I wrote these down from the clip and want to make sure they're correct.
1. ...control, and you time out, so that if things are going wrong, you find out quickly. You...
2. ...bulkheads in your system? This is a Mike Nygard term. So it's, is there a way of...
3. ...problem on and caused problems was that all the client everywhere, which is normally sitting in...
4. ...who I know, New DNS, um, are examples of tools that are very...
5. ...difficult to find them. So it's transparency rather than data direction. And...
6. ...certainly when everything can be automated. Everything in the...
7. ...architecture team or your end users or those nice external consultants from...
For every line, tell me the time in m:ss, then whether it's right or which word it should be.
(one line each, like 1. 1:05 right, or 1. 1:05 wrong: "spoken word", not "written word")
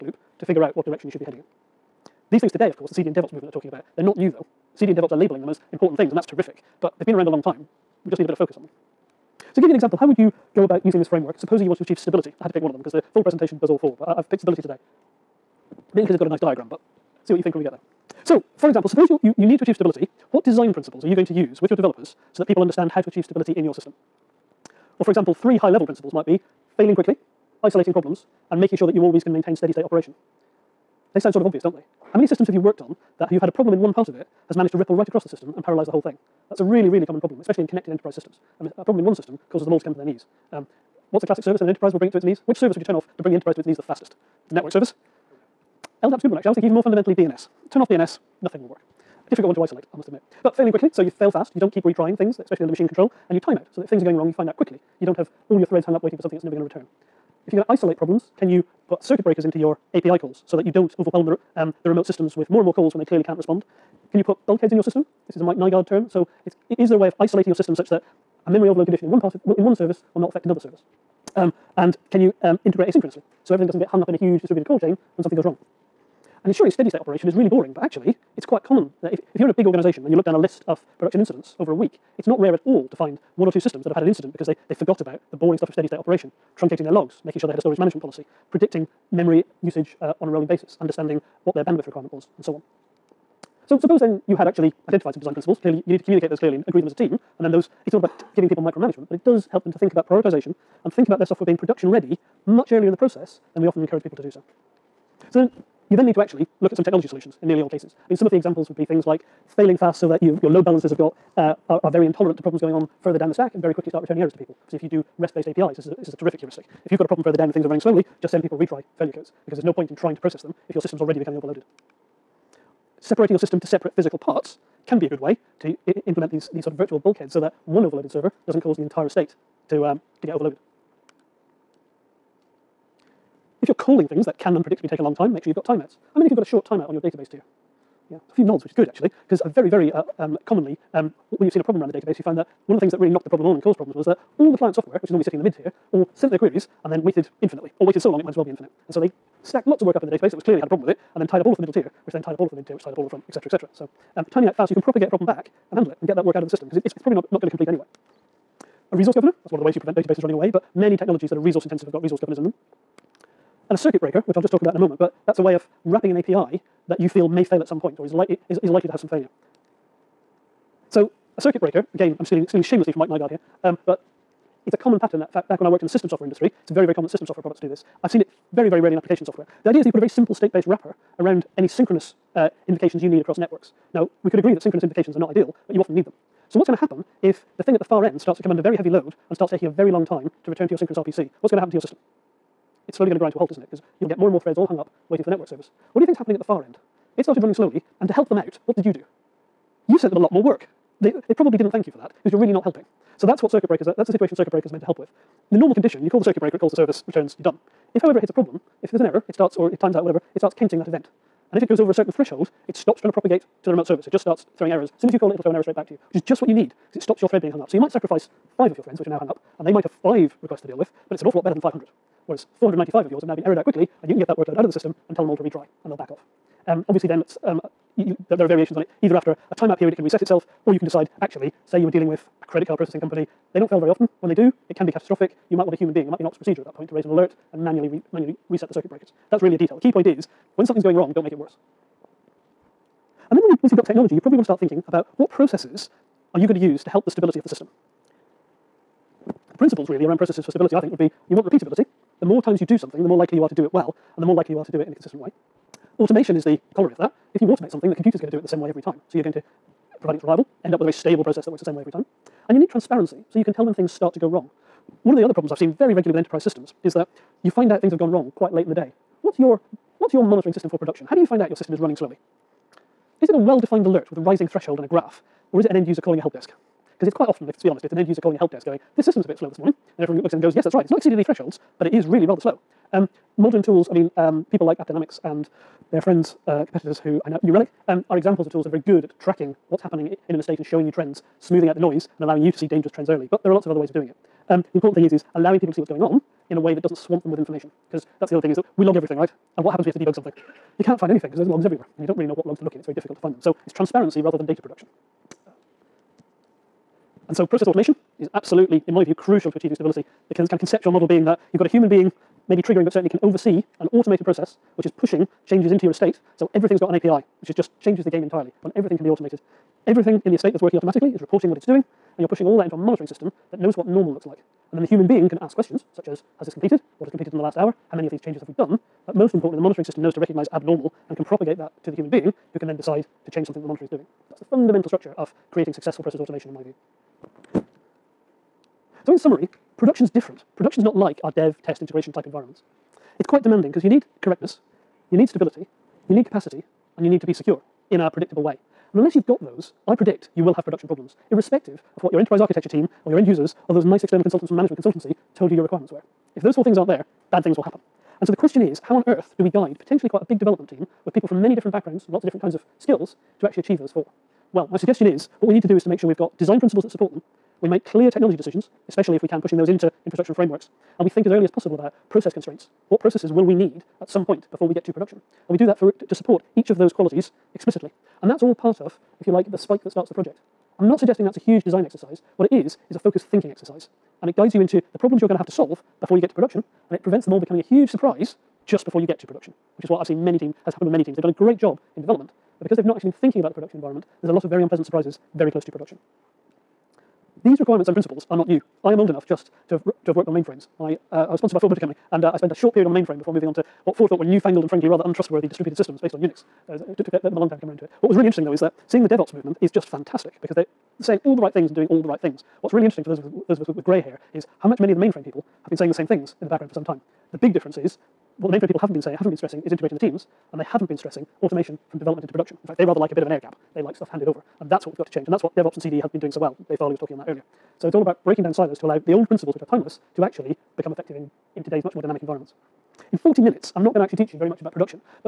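1. 0:52 right
2. 1:04 right
3. 2:23 wrong: "software", not "everywhere"
4. 4:47 wrong: "Relic", not "DNS"
5. 5:02 wrong: "production", not "direction"
6. 5:18 wrong: "entirely", not "certainly"
7. 5:52 right.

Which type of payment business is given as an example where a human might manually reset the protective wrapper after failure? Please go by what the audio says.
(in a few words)
credit card processing company.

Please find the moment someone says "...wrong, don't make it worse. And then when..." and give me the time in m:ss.
4:00.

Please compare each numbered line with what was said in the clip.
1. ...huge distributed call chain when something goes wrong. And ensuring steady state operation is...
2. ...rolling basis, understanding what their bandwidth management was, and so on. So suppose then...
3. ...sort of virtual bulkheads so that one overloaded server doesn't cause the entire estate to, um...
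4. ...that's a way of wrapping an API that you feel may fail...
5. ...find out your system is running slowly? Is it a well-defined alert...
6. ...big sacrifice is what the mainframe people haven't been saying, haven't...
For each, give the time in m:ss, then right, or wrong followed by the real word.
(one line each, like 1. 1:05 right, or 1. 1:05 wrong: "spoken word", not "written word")
1. 1:14 right
2. 1:30 wrong: "requirement", not "management"
3. 2:06 right
4. 2:45 right
5. 4:31 right
6. 6:57 wrong: "difference", not "sacrifice".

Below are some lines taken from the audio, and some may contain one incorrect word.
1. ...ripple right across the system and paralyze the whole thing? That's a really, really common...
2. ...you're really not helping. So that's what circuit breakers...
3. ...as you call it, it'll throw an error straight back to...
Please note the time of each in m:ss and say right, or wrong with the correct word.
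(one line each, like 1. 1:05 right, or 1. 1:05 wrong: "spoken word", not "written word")
1. 0:34 right
2. 3:22 right
3. 3:35 right.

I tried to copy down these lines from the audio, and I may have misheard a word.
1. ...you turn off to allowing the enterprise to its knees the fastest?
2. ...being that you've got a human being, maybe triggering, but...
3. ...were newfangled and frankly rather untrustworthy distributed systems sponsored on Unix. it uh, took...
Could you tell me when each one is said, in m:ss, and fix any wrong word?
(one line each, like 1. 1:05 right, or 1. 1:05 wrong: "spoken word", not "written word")
1. 0:42 wrong: "bring", not "allowing"
2. 5:11 right
3. 6:44 wrong: "based", not "sponsored".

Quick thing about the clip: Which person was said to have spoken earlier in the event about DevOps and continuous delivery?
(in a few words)
Dave Farley.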